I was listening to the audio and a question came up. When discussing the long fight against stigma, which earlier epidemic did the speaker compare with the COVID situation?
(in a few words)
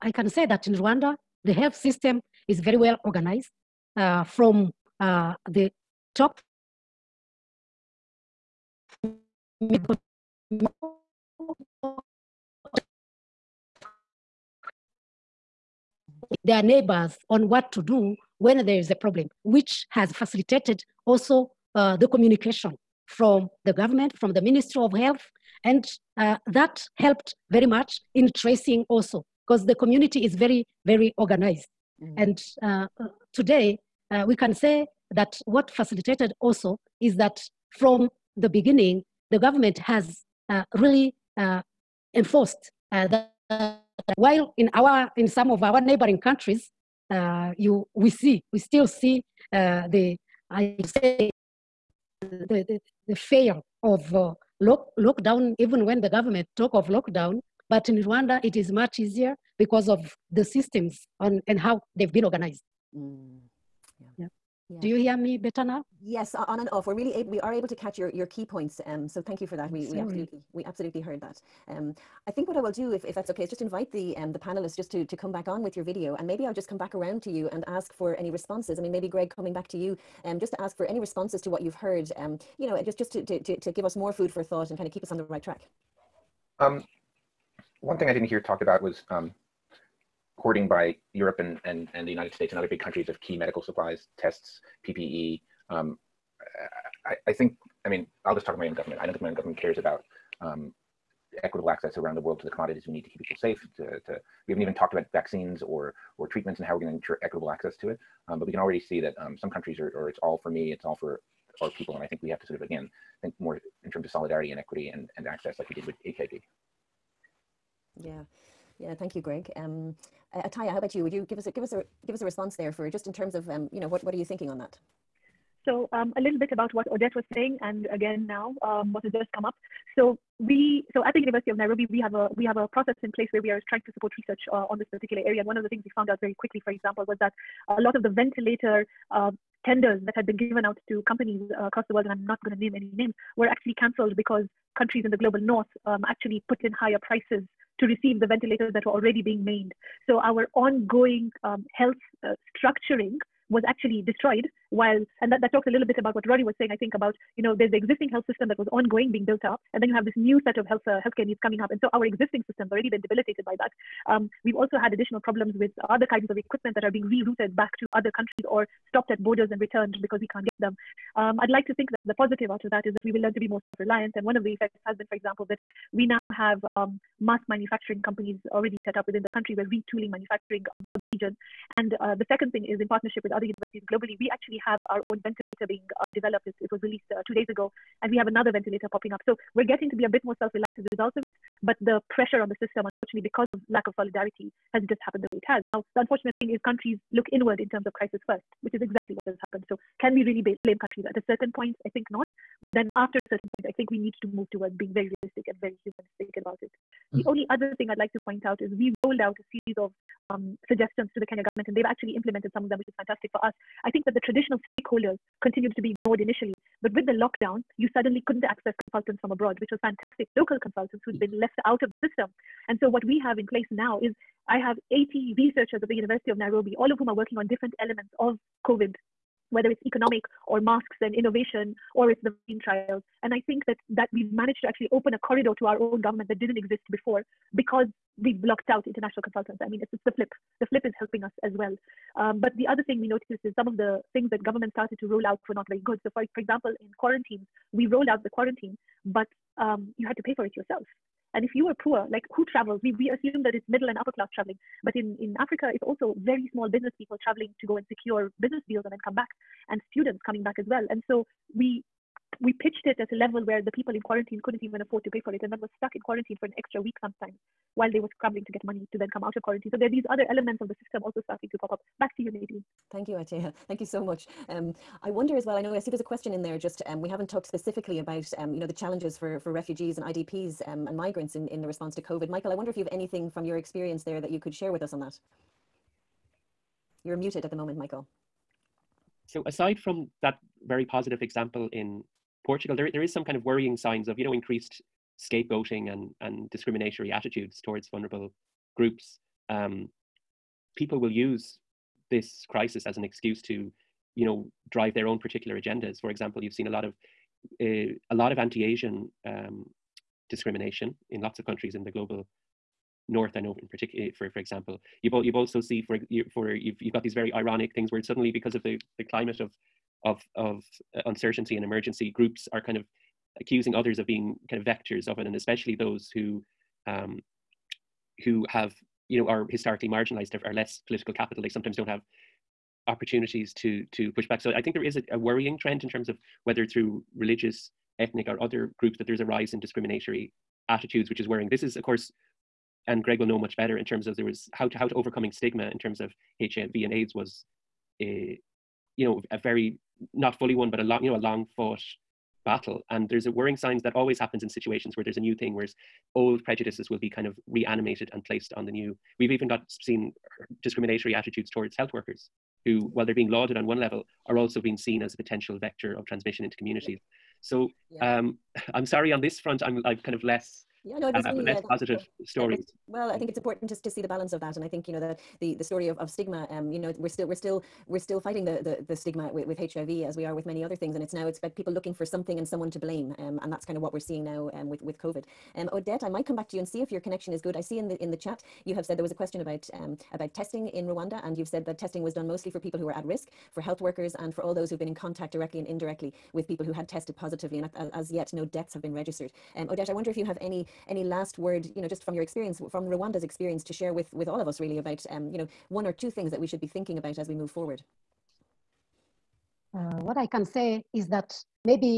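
HIV and AIDS.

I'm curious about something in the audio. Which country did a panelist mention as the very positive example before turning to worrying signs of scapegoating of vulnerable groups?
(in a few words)
Portugal.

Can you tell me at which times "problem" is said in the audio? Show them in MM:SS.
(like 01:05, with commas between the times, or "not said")
00:18, 02:45.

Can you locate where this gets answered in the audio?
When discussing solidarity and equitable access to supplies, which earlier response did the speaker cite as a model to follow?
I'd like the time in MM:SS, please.
01:56.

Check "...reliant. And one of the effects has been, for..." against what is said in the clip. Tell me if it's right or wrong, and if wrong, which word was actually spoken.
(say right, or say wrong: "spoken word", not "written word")
right.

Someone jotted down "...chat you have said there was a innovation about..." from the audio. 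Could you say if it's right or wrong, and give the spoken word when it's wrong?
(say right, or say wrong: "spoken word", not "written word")
wrong: "question", not "innovation".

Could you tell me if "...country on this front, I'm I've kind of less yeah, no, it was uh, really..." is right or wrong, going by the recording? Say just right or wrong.
wrong.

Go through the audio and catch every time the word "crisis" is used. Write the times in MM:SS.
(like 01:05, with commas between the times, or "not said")
03:17, 05:02.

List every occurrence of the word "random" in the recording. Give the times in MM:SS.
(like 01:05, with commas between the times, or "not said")
not said.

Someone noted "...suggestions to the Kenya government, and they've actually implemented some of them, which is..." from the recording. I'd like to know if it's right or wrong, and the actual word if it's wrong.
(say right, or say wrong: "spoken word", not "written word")
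right.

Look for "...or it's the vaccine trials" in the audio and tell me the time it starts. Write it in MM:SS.
03:51.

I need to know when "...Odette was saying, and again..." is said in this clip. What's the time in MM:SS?
02:06.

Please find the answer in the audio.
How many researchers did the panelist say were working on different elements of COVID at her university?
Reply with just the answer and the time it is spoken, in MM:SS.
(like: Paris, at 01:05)
80, at 03:44.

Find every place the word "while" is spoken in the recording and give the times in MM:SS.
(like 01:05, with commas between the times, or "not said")
00:44, 02:34, 04:27, 06:02.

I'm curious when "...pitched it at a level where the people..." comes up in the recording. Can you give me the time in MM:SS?
04:22.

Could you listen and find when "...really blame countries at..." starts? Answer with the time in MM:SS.
03:20.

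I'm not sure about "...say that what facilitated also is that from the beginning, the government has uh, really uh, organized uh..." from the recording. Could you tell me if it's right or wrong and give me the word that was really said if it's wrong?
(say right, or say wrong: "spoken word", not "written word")
wrong: "enforced", not "organized".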